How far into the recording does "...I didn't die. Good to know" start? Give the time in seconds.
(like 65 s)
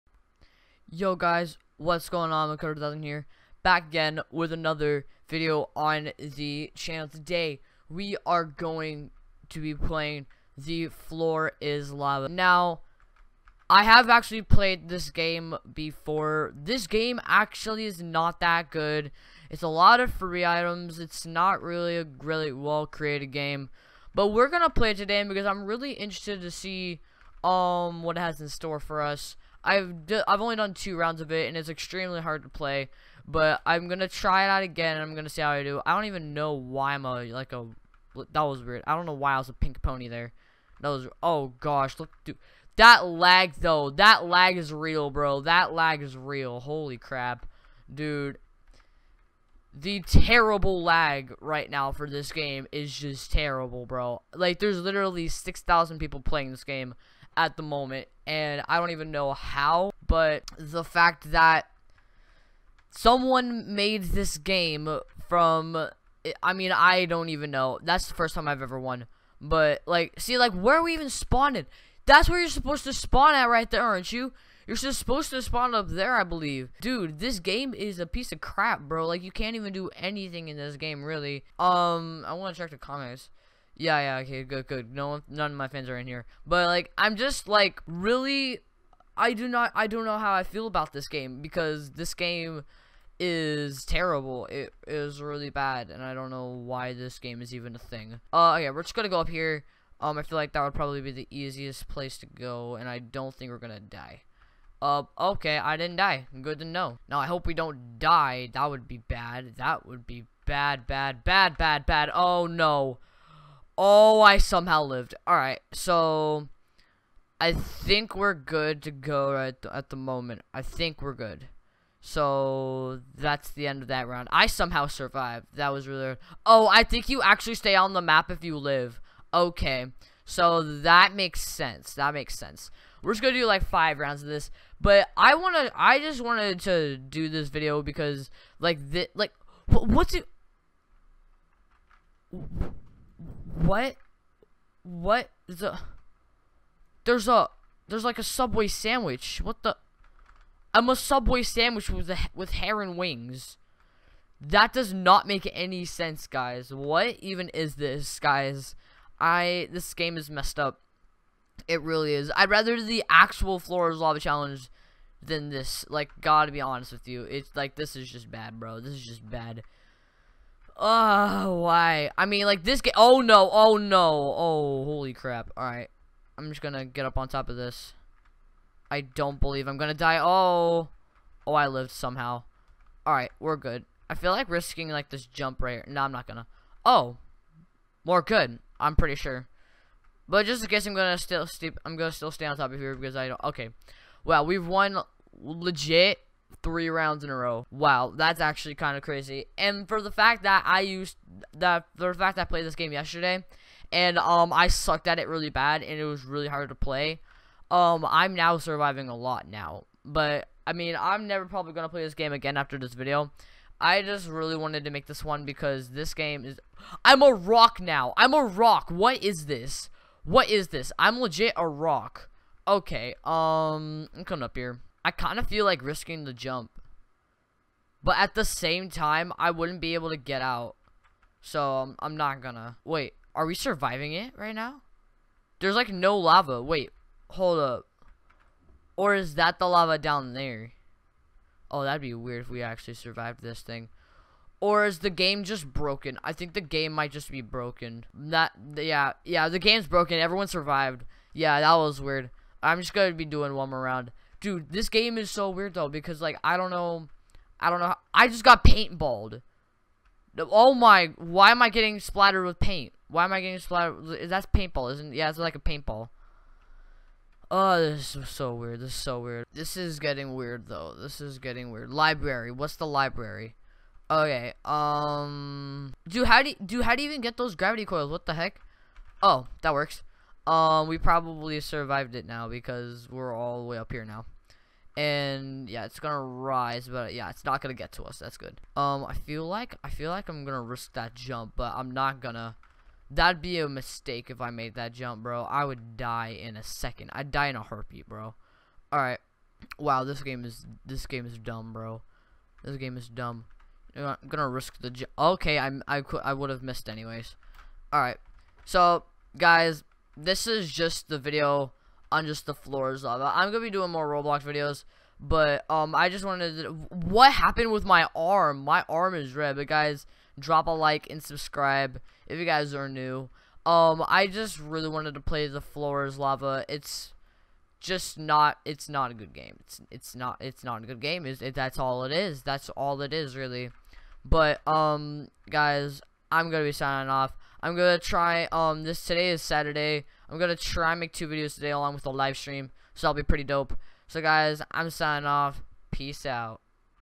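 105 s.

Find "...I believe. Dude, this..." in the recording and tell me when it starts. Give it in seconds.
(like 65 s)
76 s.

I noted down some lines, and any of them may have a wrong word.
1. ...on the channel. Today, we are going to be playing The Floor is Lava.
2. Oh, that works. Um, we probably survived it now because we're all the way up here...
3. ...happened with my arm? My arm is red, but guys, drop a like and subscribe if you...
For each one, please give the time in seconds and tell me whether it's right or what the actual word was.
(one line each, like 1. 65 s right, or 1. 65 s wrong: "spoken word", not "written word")
1. 5 s right
2. 279 s right
3. 317 s right.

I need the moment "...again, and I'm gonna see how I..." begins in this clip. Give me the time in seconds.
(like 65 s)
34 s.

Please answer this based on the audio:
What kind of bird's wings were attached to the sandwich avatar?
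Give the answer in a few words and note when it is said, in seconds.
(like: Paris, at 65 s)
heron, at 152 s.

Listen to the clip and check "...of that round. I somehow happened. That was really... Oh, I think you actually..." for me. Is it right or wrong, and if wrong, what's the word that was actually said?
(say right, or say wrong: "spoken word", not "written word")
wrong: "survived", not "happened".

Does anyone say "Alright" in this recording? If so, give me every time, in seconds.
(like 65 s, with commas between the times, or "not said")
115 s, 175 s, 183 s.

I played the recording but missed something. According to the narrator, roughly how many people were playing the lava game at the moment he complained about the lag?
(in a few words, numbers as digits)
6,000.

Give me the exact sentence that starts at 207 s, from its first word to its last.
Um, I'm now surviving a lot now, but I mean, I'm never probably gonna play this game again after this video.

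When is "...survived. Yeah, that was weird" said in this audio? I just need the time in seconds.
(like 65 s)
250 s.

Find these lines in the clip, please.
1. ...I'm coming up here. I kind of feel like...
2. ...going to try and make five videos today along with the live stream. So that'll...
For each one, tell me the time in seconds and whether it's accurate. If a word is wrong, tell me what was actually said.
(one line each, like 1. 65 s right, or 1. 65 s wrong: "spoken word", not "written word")
1. 224 s right
2. 340 s wrong: "two", not "five".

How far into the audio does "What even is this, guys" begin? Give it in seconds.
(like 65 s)
156 s.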